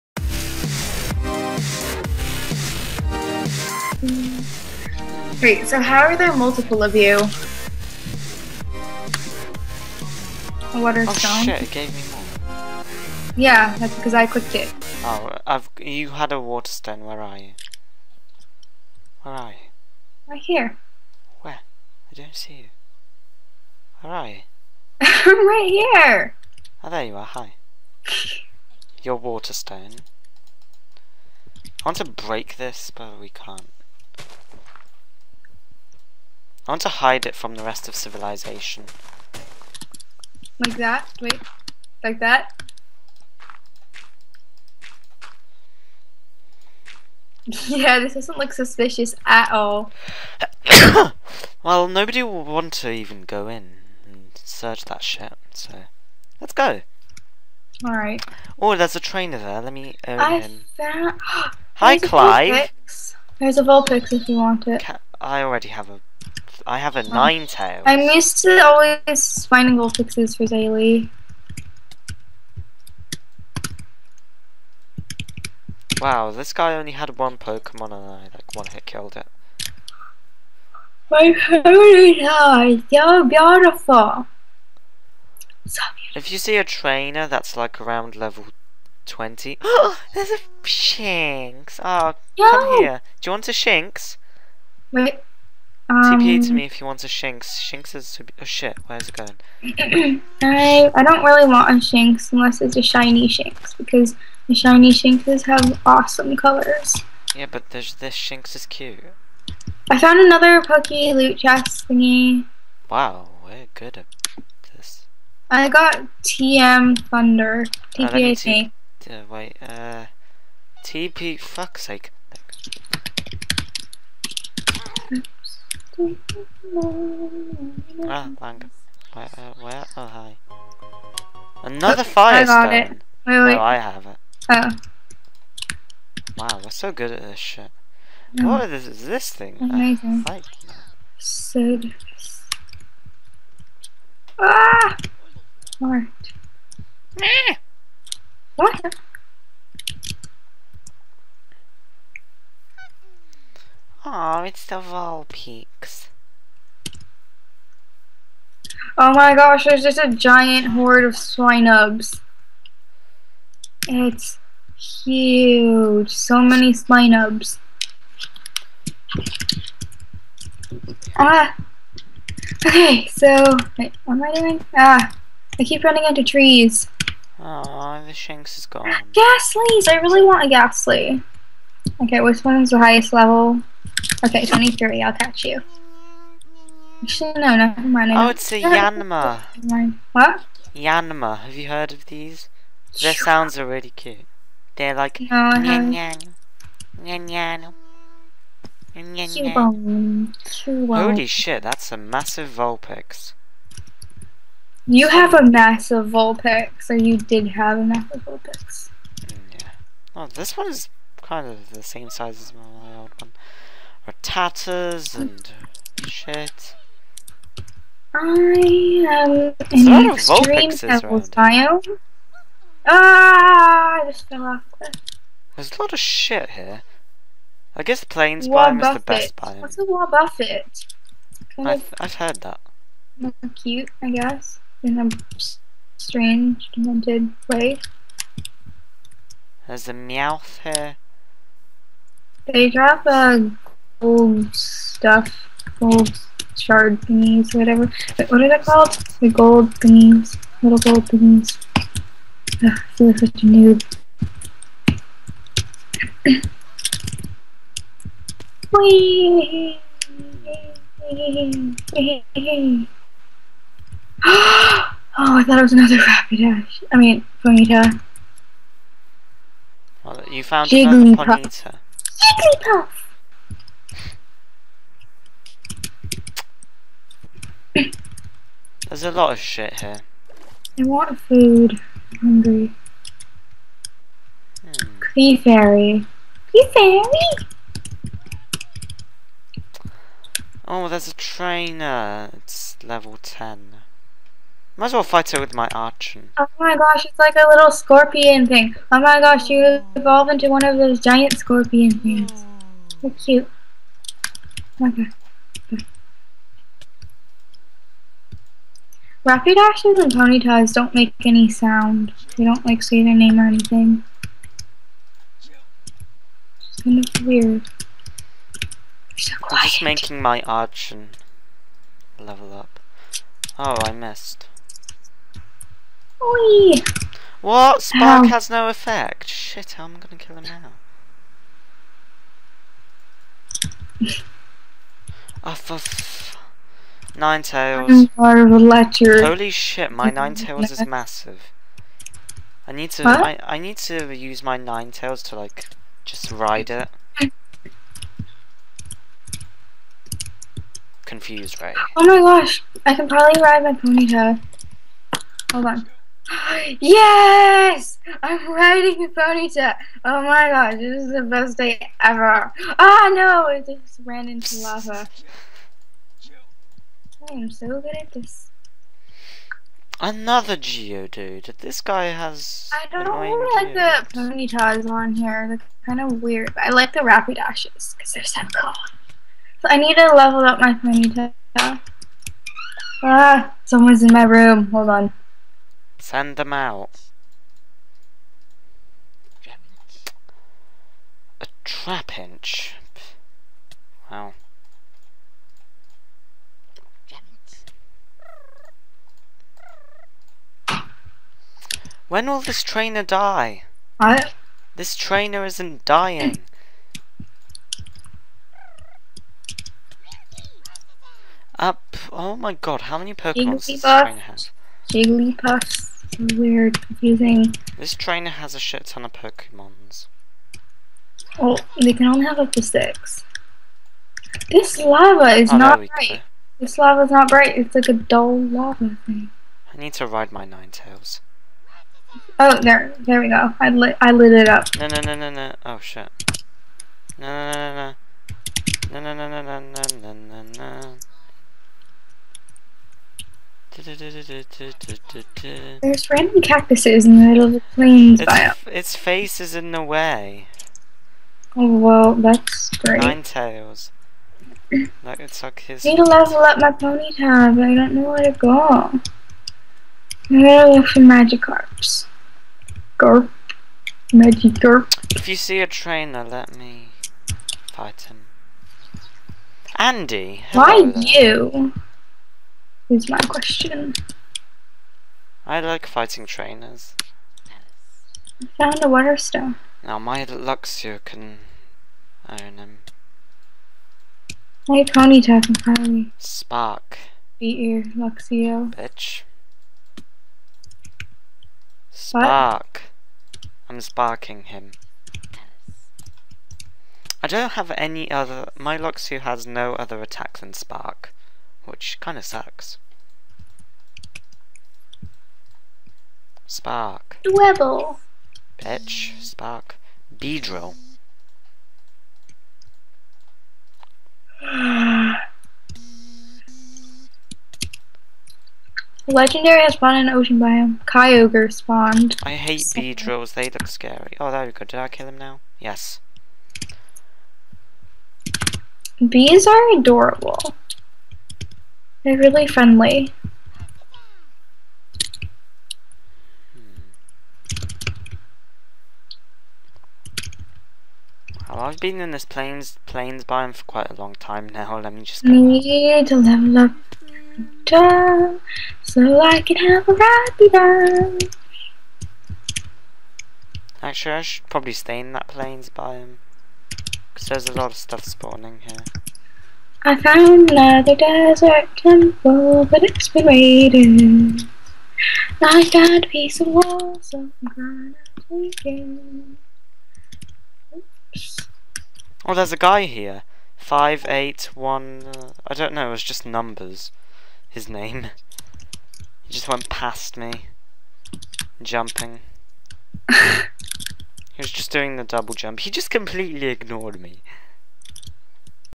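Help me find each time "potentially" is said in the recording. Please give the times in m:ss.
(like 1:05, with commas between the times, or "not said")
not said.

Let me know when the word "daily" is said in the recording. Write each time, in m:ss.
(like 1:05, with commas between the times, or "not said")
1:10.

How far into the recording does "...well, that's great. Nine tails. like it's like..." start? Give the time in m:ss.
7:31.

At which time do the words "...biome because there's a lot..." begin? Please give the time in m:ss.
9:15.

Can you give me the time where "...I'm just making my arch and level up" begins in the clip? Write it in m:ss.
5:19.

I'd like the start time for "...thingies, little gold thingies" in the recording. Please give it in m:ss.
4:09.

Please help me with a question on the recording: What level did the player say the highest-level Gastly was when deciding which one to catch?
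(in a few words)
23.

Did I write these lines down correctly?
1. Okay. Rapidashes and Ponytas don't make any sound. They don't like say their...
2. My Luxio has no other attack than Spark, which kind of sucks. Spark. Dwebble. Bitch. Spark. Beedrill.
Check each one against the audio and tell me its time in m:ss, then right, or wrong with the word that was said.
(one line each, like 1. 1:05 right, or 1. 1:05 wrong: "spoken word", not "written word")
1. 5:04 right
2. 8:18 right.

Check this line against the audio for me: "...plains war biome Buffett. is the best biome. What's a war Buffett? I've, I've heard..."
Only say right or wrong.
right.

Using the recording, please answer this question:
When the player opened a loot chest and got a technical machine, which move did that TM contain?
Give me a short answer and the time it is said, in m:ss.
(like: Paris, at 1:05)
Thunder, at 1:56.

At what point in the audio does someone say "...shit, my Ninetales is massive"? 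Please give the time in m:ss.
5:39.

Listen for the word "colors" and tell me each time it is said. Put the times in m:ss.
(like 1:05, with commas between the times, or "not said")
1:46.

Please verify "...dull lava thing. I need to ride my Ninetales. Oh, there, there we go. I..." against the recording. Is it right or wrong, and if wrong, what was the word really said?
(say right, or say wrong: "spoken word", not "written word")
right.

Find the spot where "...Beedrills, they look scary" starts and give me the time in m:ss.
8:42.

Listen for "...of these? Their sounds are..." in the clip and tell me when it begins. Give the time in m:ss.
3:11.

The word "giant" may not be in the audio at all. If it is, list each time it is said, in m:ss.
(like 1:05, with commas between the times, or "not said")
2:40, 5:00.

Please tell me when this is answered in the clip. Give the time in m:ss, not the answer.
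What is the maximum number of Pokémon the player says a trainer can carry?
7:02.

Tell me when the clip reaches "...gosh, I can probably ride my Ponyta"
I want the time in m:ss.
5:52.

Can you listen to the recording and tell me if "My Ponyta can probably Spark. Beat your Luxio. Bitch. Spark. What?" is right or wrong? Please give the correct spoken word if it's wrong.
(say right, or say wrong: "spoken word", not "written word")
right.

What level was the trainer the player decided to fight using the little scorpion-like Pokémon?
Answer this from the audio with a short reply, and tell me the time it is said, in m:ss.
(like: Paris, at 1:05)
10, at 4:52.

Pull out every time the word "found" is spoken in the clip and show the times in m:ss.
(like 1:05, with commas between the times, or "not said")
1:00, 1:49, 4:30, 7:58, 9:19, 9:25.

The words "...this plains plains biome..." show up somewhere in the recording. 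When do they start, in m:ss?
9:02.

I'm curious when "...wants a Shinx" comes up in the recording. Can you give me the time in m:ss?
1:36.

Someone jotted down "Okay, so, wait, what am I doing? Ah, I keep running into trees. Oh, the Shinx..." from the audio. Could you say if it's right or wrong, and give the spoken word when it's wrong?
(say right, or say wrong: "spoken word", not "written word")
right.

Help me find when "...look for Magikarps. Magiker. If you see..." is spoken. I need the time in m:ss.
7:40.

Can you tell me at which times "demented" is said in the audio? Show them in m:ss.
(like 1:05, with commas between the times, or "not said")
3:56.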